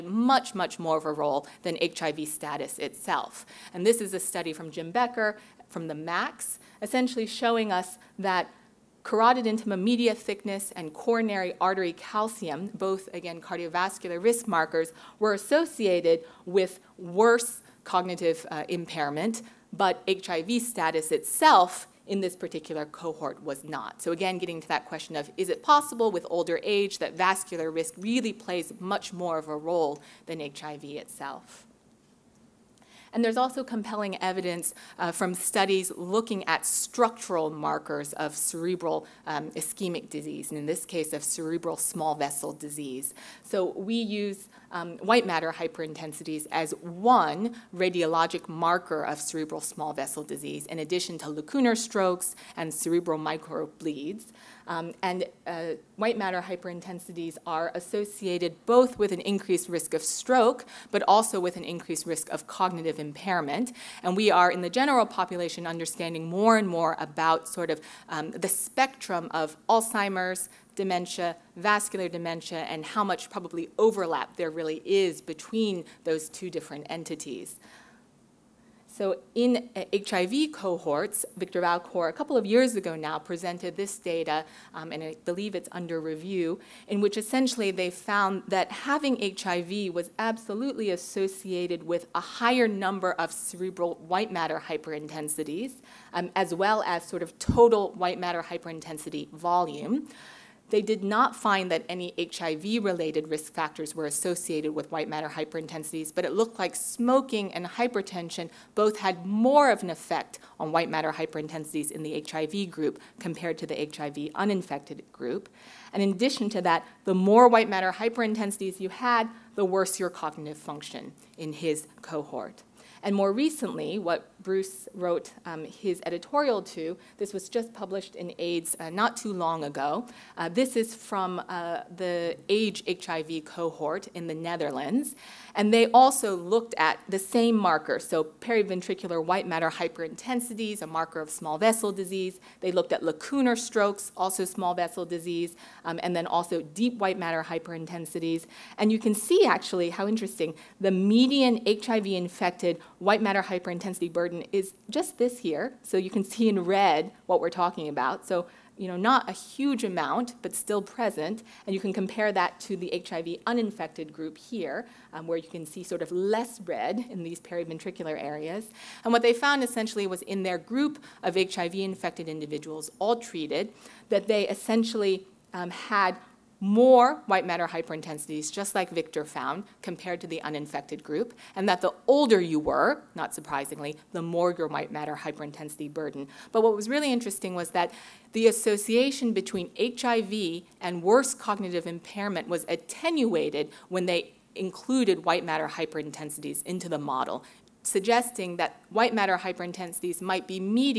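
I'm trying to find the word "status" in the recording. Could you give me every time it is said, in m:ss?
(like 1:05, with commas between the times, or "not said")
0:02, 0:20.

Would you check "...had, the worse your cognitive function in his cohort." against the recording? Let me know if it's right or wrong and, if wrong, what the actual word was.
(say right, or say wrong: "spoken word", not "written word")
right.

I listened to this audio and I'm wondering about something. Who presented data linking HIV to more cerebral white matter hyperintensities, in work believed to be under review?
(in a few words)
Victor Valcour.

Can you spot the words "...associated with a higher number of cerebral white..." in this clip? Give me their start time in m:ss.
1:30.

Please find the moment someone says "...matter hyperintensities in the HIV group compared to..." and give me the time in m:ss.
1:50.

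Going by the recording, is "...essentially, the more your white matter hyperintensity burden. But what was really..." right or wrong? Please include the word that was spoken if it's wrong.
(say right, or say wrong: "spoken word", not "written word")
wrong: "surprisingly", not "essentially".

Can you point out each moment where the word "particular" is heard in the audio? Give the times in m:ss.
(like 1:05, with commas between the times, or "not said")
0:22.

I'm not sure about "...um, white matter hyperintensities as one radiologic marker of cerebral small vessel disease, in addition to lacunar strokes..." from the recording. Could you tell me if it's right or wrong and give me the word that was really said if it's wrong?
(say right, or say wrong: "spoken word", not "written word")
right.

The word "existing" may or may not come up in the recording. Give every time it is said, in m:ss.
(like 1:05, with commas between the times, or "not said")
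not said.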